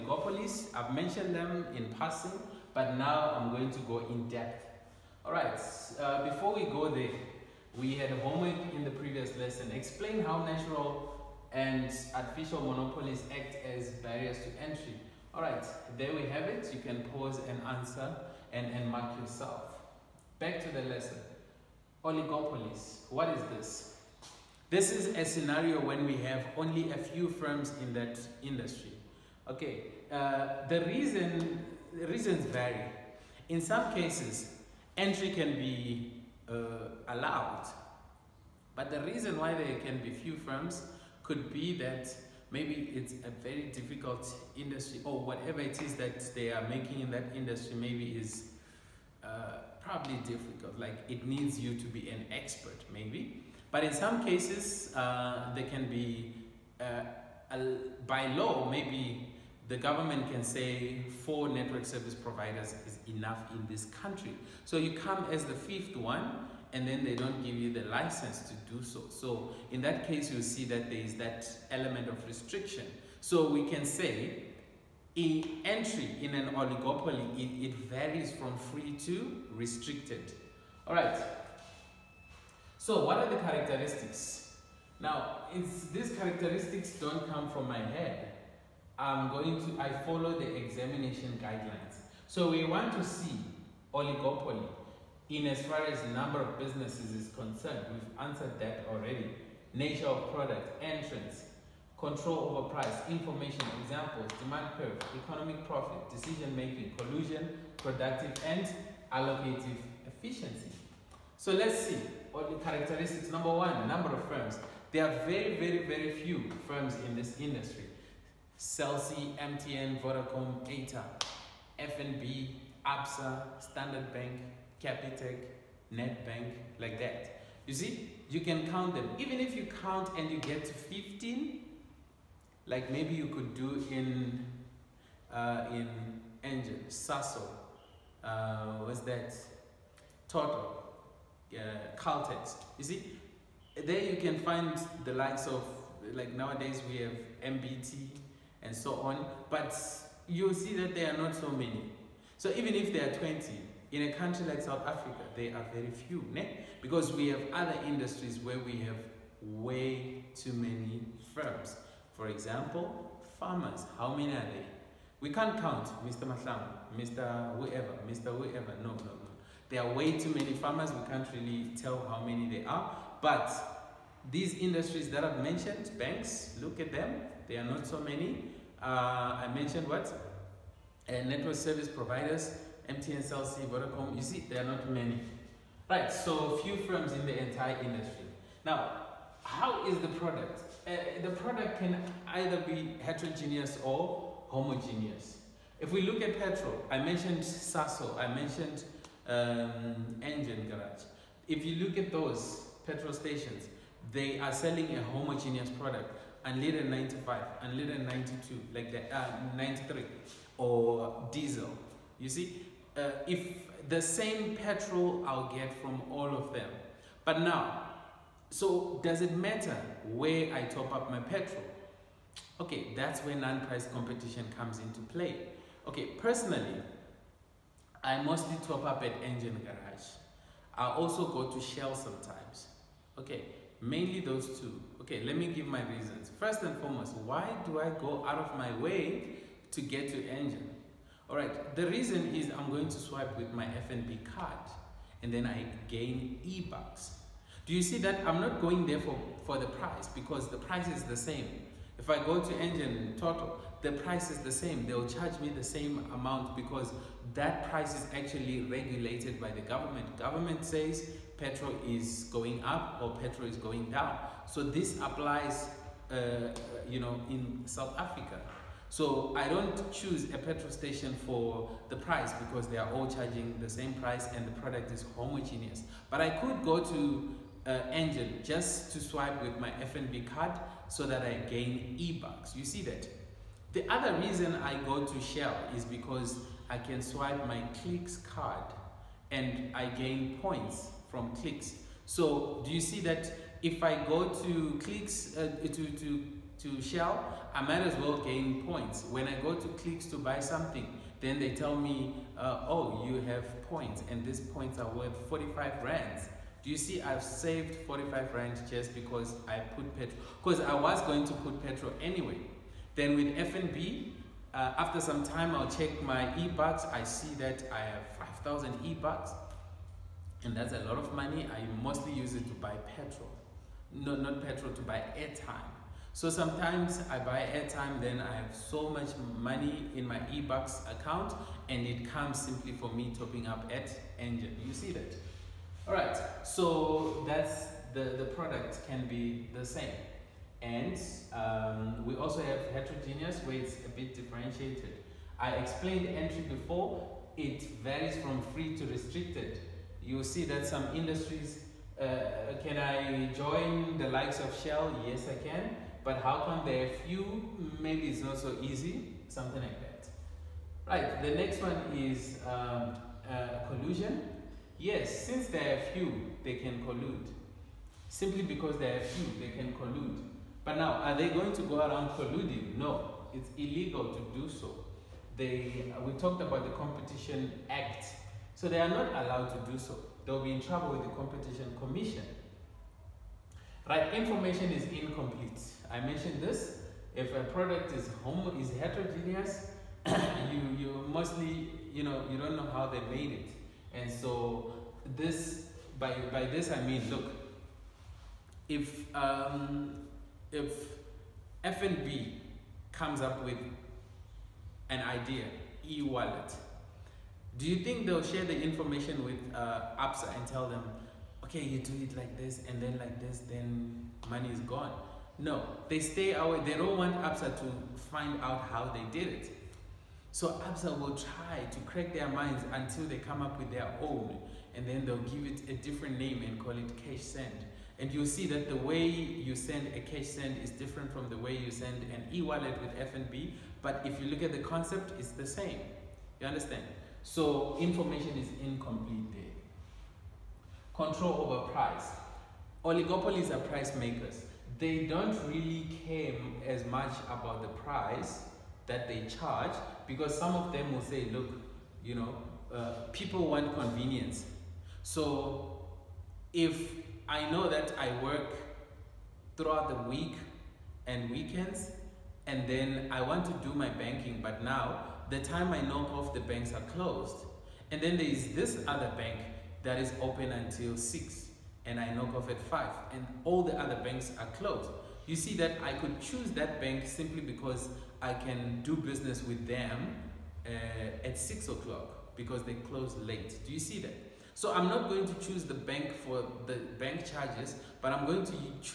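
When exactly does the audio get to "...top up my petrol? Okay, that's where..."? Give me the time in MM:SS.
03:40.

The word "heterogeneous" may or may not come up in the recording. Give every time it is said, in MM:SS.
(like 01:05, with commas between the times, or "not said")
03:13, 05:42, 06:28.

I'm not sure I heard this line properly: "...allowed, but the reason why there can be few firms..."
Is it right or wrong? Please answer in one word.
right.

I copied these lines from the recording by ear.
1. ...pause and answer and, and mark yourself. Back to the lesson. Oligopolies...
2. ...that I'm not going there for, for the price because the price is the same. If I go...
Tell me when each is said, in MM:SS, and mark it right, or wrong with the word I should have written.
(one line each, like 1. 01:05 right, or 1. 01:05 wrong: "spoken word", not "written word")
1. 00:17 right
2. 04:07 right.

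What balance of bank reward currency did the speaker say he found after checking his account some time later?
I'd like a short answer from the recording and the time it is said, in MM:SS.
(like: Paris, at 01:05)
5,000 eBucks, at 05:18.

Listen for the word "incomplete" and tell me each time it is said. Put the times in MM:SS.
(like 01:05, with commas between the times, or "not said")
06:24, 07:18.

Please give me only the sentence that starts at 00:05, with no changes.
All right, uh, before we go there, we had a homework in the previous lesson.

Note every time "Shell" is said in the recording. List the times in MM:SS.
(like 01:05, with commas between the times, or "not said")
03:51, 04:45, 04:56, 05:54.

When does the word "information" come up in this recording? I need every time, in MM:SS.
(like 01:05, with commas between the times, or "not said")
01:43, 06:24, 06:48, 07:17.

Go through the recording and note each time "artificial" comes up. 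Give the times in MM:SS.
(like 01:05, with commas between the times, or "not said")
00:12.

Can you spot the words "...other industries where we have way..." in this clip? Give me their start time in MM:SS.
02:37.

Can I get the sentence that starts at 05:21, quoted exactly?
I mostly use it to buy petrol.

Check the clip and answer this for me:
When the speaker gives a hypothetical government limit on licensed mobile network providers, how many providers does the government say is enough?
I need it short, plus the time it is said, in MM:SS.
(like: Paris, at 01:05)
4, at 01:01.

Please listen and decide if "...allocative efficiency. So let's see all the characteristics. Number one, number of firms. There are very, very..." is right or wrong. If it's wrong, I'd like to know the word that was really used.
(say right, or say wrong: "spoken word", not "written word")
right.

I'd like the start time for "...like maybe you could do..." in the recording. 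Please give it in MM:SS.
02:12.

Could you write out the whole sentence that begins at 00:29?
Okay, uh, the reason the reasons vary.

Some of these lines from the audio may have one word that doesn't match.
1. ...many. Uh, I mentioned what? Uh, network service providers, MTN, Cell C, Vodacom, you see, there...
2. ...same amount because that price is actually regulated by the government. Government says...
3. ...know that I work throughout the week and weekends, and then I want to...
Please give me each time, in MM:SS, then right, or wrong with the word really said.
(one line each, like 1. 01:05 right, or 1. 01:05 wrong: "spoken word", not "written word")
1. 02:57 right
2. 04:15 right
3. 07:37 right.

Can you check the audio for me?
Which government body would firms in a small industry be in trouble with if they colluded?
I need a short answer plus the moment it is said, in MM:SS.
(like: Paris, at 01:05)
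Competition Commission, at 06:21.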